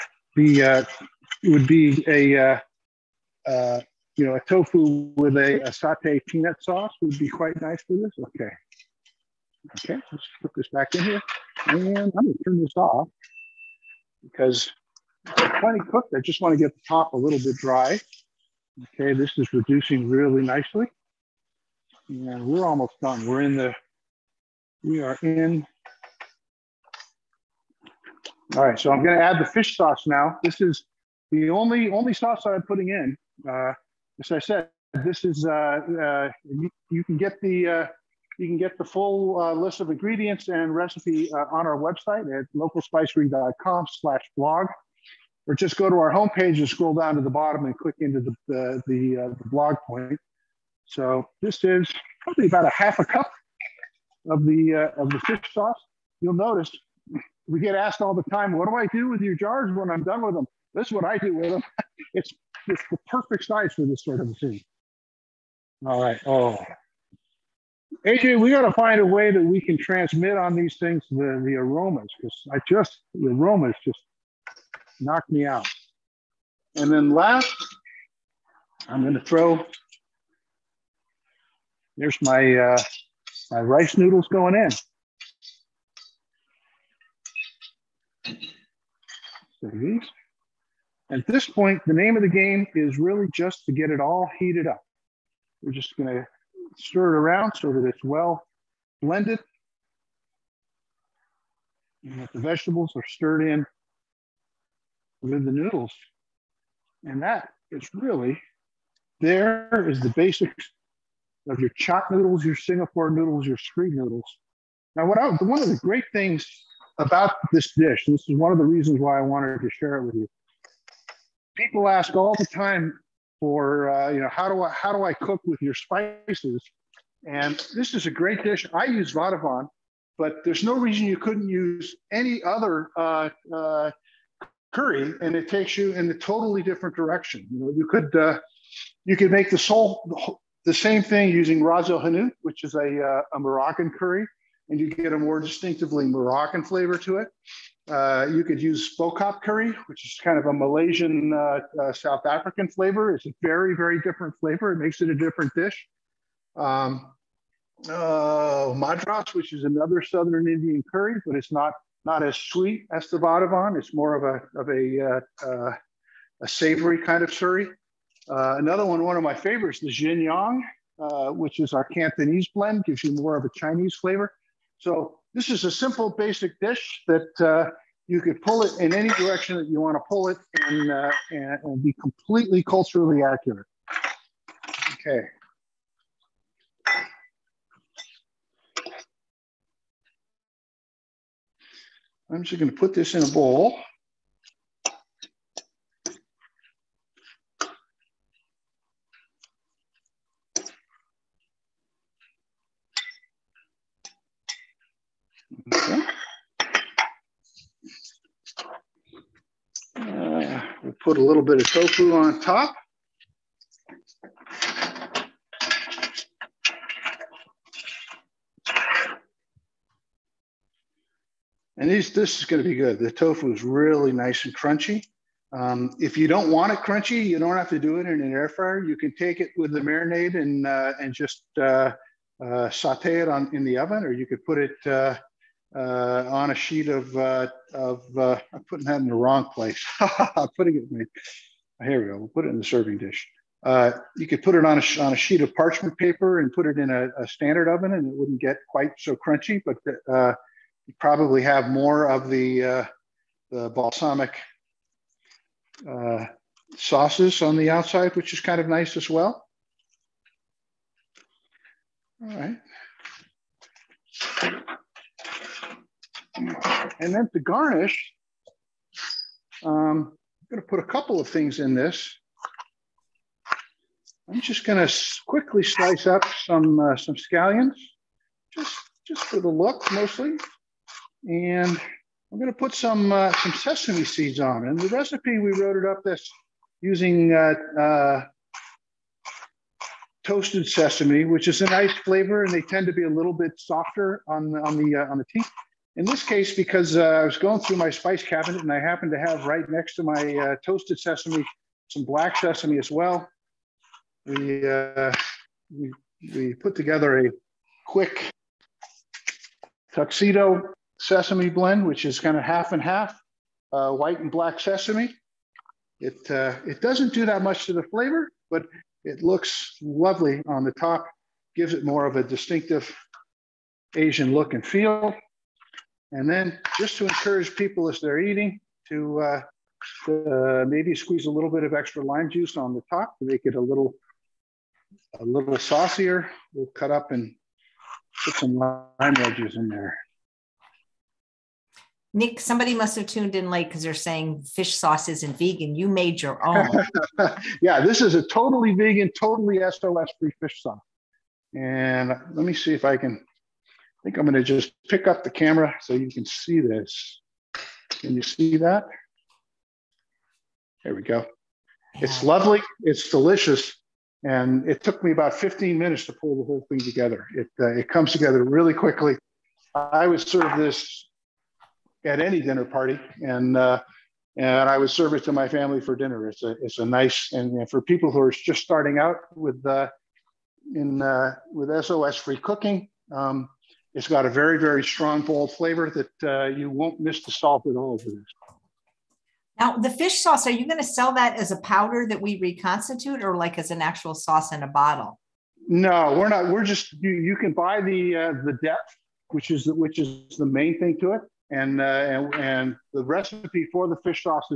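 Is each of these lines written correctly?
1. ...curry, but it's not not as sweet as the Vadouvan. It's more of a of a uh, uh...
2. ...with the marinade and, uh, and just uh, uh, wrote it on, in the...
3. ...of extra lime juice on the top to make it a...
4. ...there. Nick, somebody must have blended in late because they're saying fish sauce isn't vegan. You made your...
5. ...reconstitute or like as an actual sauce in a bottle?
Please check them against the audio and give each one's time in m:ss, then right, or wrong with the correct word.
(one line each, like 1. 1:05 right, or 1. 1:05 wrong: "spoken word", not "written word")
1. 2:40 right
2. 3:49 wrong: "saute", not "wrote"
3. 5:31 right
4. 5:39 wrong: "tuned", not "blended"
5. 6:32 right.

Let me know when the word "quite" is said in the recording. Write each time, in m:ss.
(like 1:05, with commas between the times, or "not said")
0:07, 4:08.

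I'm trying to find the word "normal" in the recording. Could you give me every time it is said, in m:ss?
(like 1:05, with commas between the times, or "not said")
not said.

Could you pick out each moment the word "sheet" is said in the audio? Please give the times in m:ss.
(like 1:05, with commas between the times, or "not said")
3:56, 4:05.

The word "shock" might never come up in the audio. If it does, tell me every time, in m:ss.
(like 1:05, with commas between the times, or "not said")
not said.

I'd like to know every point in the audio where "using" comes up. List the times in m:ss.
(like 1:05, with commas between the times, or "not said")
2:21, 4:46.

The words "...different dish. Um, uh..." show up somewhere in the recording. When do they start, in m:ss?
2:35.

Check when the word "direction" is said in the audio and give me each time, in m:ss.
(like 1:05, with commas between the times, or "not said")
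2:16, 2:59.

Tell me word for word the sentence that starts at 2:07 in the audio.
And this is a great dish.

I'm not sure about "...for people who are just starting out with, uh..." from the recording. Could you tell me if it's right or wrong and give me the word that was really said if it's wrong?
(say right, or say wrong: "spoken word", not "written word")
right.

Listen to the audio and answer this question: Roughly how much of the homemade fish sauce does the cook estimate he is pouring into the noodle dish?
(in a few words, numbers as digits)
half a cup.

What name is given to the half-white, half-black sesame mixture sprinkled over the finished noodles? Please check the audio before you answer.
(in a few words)
tuxedo sesame.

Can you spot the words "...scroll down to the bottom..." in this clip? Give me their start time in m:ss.
0:46.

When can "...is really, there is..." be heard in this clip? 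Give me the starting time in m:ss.
1:47.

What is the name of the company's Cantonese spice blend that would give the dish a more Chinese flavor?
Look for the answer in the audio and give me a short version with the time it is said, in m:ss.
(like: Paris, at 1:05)
Jin Yong, at 2:49.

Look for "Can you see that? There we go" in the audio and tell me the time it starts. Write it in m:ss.
5:58.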